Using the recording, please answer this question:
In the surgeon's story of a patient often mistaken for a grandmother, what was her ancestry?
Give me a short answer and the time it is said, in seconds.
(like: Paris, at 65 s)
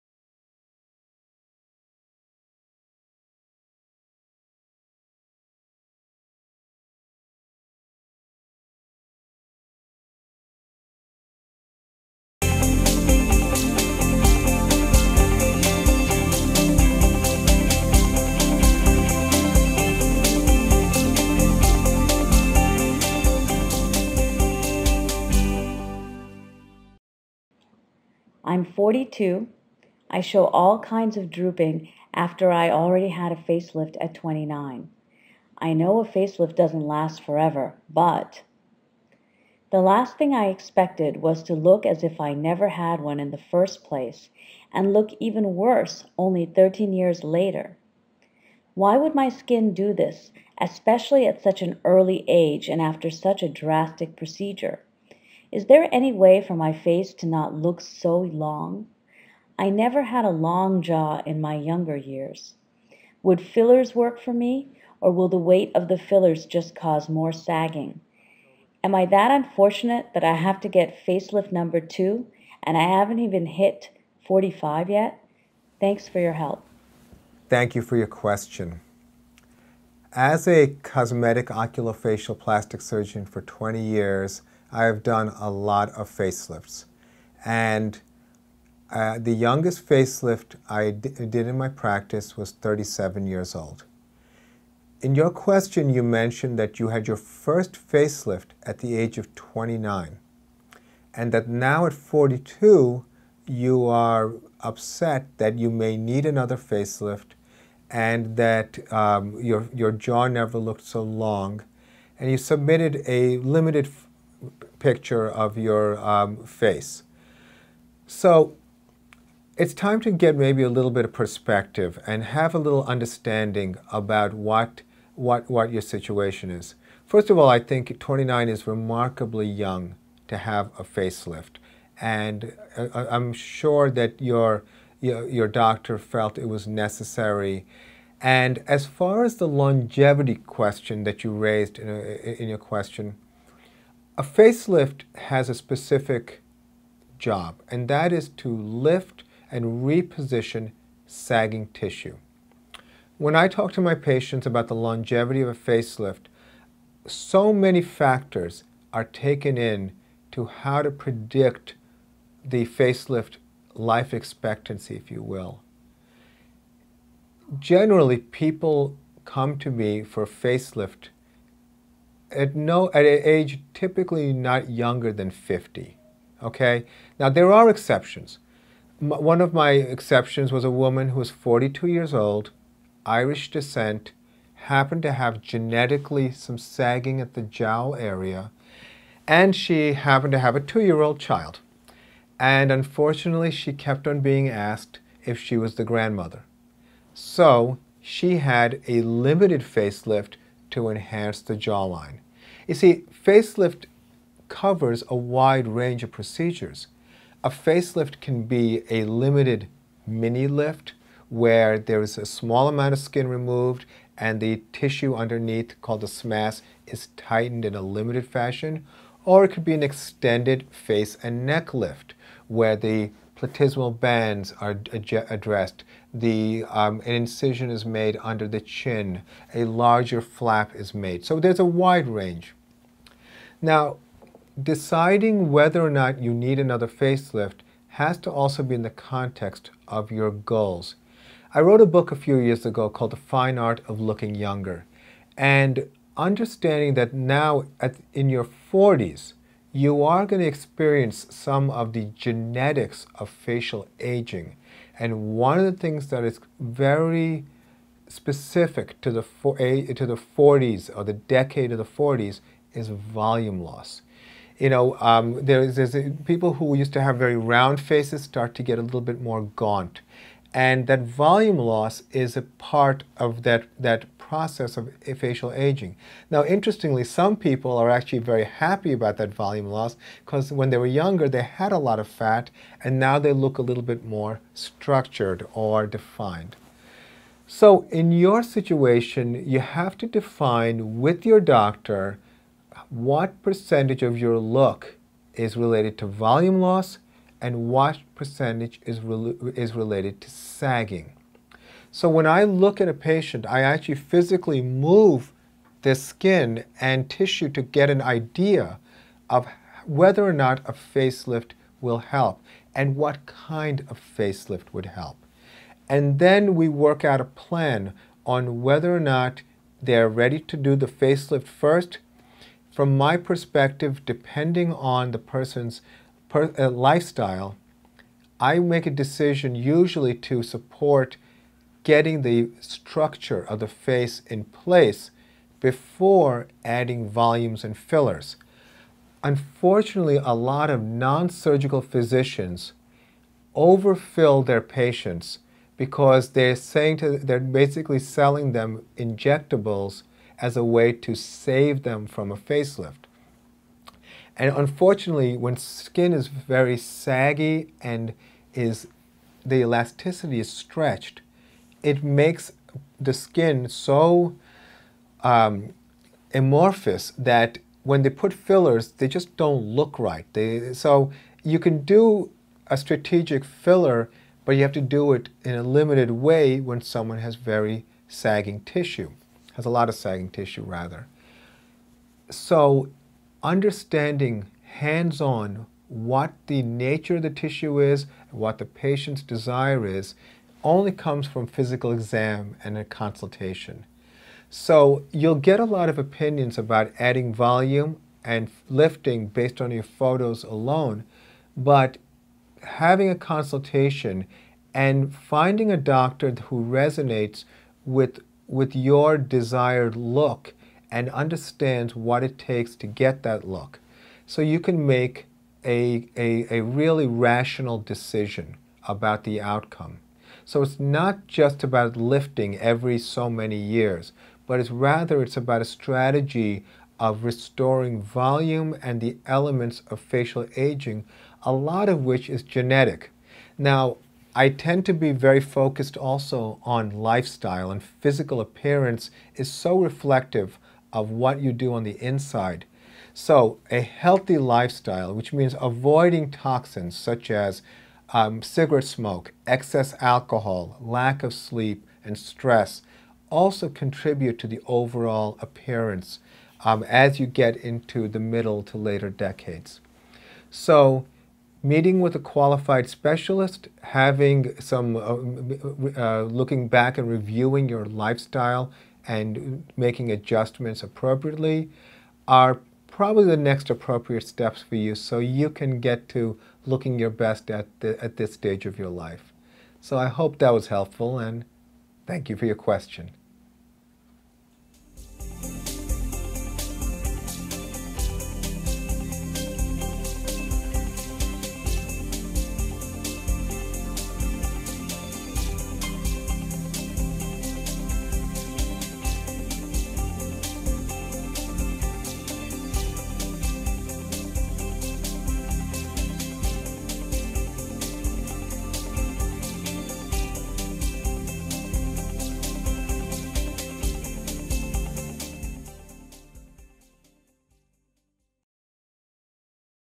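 Irish, at 183 s.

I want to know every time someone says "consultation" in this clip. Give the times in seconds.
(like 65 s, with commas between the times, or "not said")
392 s, 403 s.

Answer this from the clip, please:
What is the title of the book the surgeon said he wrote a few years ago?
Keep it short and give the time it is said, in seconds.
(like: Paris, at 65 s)
The Fine Art of Looking Younger, at 243 s.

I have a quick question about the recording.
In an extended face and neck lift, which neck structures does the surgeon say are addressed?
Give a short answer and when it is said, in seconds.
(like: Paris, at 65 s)
platysmal bands, at 223 s.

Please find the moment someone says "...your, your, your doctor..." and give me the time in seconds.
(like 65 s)
134 s.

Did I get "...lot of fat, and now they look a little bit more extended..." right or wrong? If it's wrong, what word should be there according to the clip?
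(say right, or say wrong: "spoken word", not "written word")
wrong: "structured", not "extended".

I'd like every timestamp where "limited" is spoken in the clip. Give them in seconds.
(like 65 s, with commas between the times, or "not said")
113 s, 199 s, 209 s, 217 s, 375 s.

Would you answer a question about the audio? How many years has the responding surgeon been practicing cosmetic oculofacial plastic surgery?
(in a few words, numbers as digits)
20.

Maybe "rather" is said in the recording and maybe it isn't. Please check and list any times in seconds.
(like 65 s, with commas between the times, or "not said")
380 s, 424 s.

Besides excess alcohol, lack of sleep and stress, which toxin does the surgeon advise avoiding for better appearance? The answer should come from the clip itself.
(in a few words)
cigarette smoke.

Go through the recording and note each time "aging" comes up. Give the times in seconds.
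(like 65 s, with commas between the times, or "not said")
253 s, 275 s, 430 s.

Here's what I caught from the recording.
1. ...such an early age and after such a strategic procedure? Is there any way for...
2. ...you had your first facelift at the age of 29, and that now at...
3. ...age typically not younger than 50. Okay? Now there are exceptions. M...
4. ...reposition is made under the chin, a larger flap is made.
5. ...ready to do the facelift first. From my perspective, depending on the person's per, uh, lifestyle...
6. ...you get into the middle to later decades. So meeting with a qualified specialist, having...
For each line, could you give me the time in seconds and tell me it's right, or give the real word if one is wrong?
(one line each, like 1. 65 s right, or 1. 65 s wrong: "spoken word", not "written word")
1. 51 s wrong: "drastic", not "strategic"
2. 96 s right
3. 173 s right
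4. 227 s wrong: "incision", not "reposition"
5. 320 s right
6. 457 s right.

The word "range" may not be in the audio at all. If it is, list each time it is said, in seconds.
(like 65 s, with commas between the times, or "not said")
205 s, 232 s.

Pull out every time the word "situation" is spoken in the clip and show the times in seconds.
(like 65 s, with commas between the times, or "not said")
125 s, 288 s.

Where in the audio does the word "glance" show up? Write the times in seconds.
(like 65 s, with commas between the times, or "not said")
not said.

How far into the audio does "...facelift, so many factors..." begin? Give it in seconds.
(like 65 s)
155 s.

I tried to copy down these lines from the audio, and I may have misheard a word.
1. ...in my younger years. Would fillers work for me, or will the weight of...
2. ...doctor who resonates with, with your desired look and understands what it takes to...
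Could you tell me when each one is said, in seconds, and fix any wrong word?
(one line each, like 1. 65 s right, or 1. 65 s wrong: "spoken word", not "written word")
1. 61 s right
2. 405 s right.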